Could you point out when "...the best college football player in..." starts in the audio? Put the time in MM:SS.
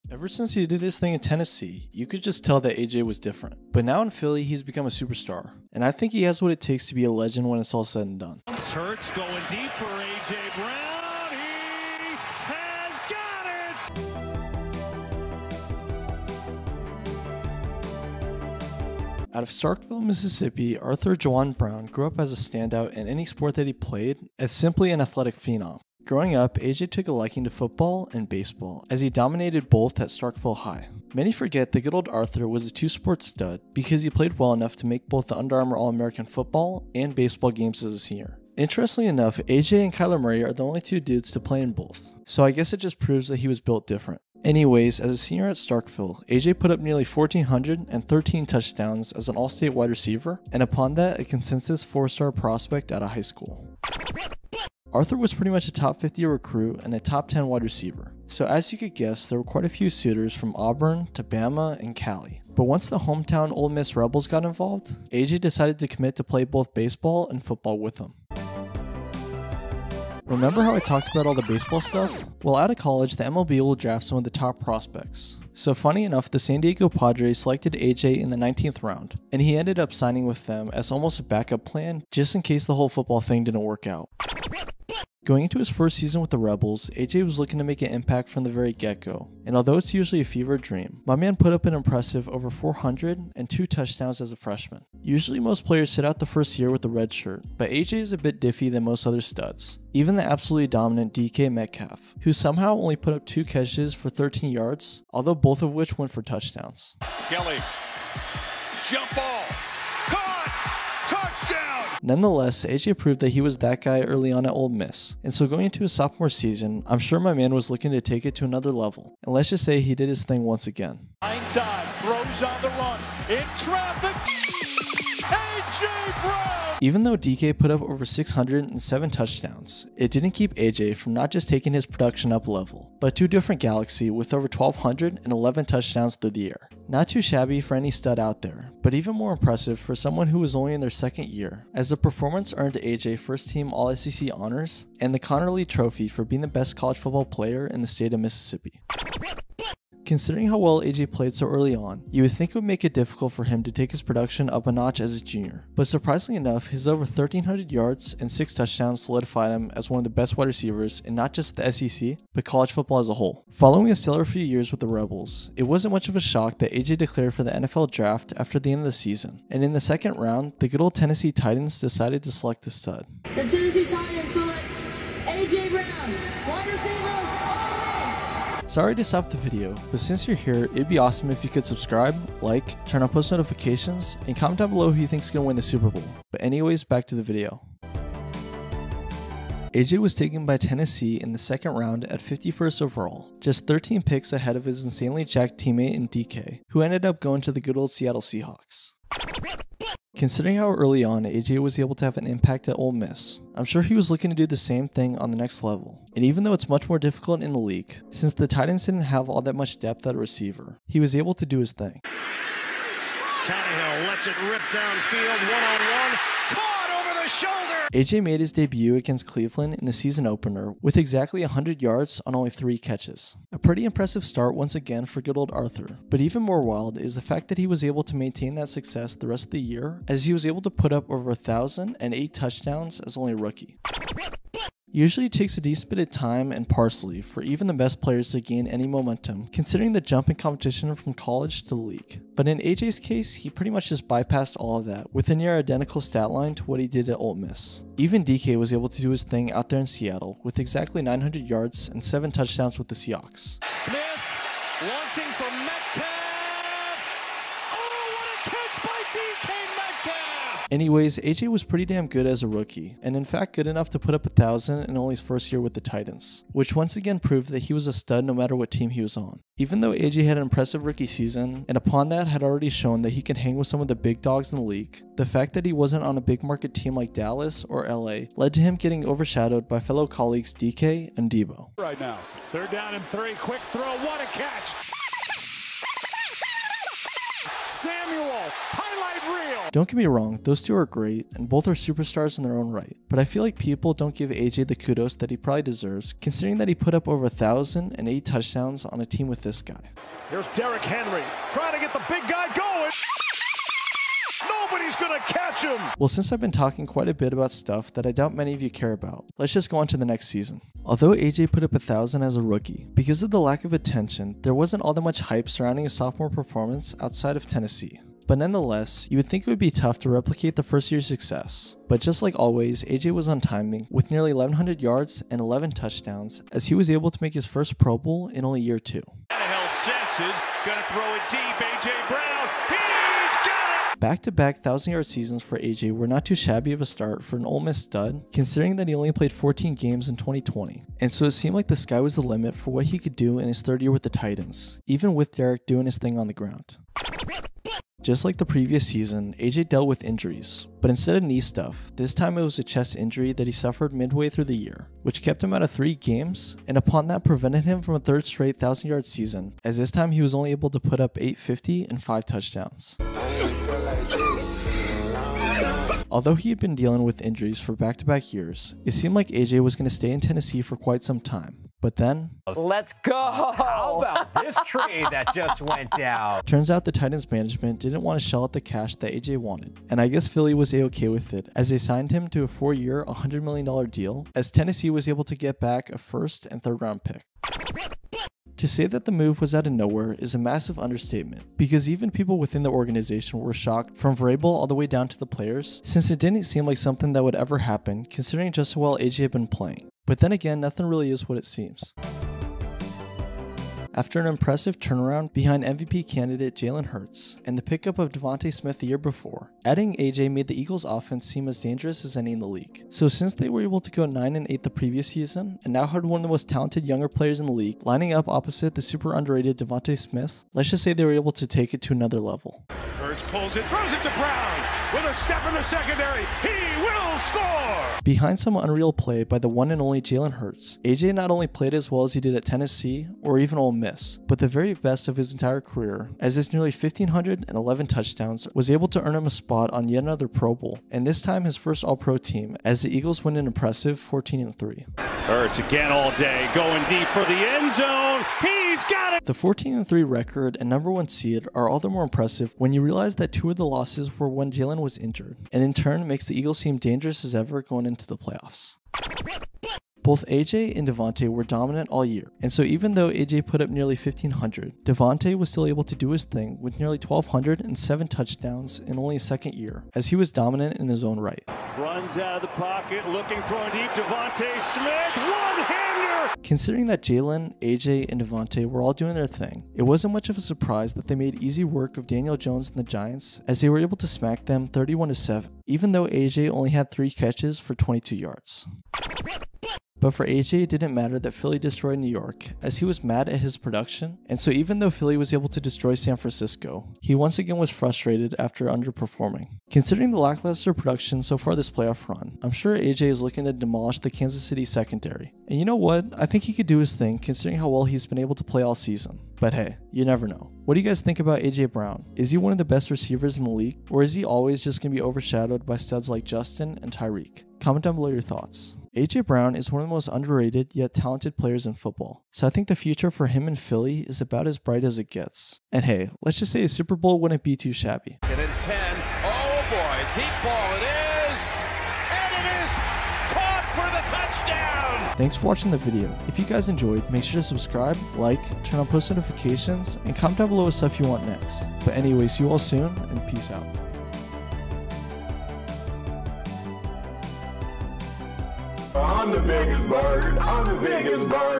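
02:26.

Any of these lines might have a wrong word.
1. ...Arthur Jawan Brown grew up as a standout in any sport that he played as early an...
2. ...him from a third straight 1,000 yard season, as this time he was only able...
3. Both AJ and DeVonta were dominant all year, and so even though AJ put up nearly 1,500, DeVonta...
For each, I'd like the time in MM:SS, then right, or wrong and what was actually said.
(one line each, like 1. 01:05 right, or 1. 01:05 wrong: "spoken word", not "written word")
1. 00:20 wrong: "simply", not "early"
2. 05:57 right
3. 07:40 right.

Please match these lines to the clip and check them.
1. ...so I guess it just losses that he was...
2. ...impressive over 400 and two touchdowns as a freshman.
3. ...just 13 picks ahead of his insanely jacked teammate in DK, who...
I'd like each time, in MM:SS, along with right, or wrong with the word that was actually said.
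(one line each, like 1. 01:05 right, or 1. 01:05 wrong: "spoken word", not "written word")
1. 00:42 wrong: "proves", not "losses"
2. 01:31 right
3. 03:13 right.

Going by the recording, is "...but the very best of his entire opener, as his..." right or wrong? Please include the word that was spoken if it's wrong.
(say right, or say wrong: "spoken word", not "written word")
wrong: "career", not "opener".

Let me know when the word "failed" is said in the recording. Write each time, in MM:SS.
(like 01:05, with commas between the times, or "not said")
not said.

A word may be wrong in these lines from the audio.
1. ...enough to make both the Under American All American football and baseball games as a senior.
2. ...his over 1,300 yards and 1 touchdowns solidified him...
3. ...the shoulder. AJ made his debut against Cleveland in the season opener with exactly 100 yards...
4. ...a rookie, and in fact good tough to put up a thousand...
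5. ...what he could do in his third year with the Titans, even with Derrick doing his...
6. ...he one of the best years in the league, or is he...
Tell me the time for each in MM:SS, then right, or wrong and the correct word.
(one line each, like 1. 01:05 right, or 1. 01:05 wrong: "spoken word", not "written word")
1. 00:34 wrong: "Armour", not "American"
2. 02:36 wrong: "6", not "1"
3. 03:37 right
4. 04:22 wrong: "enough", not "tough"
5. 05:42 right
6. 08:32 wrong: "receivers", not "years".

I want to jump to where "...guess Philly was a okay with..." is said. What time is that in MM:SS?
06:20.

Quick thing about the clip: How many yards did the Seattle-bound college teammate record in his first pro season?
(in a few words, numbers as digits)
900.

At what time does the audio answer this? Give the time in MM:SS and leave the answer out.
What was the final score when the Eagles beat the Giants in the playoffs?
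08:04.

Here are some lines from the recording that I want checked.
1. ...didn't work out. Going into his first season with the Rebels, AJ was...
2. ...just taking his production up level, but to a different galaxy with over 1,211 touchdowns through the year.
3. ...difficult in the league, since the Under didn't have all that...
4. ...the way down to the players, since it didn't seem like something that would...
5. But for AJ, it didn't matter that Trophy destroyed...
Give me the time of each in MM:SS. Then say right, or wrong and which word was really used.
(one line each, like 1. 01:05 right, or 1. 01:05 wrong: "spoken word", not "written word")
1. 01:23 right
2. 02:11 right
3. 03:26 wrong: "Titans", not "Under"
4. 06:34 right
5. 08:10 wrong: "Philly", not "Trophy".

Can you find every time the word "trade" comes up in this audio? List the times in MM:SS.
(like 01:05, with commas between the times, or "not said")
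06:14.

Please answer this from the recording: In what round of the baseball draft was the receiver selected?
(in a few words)
19th round.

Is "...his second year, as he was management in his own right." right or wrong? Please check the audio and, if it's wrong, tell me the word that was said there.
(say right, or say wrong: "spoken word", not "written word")
wrong: "dominant", not "management".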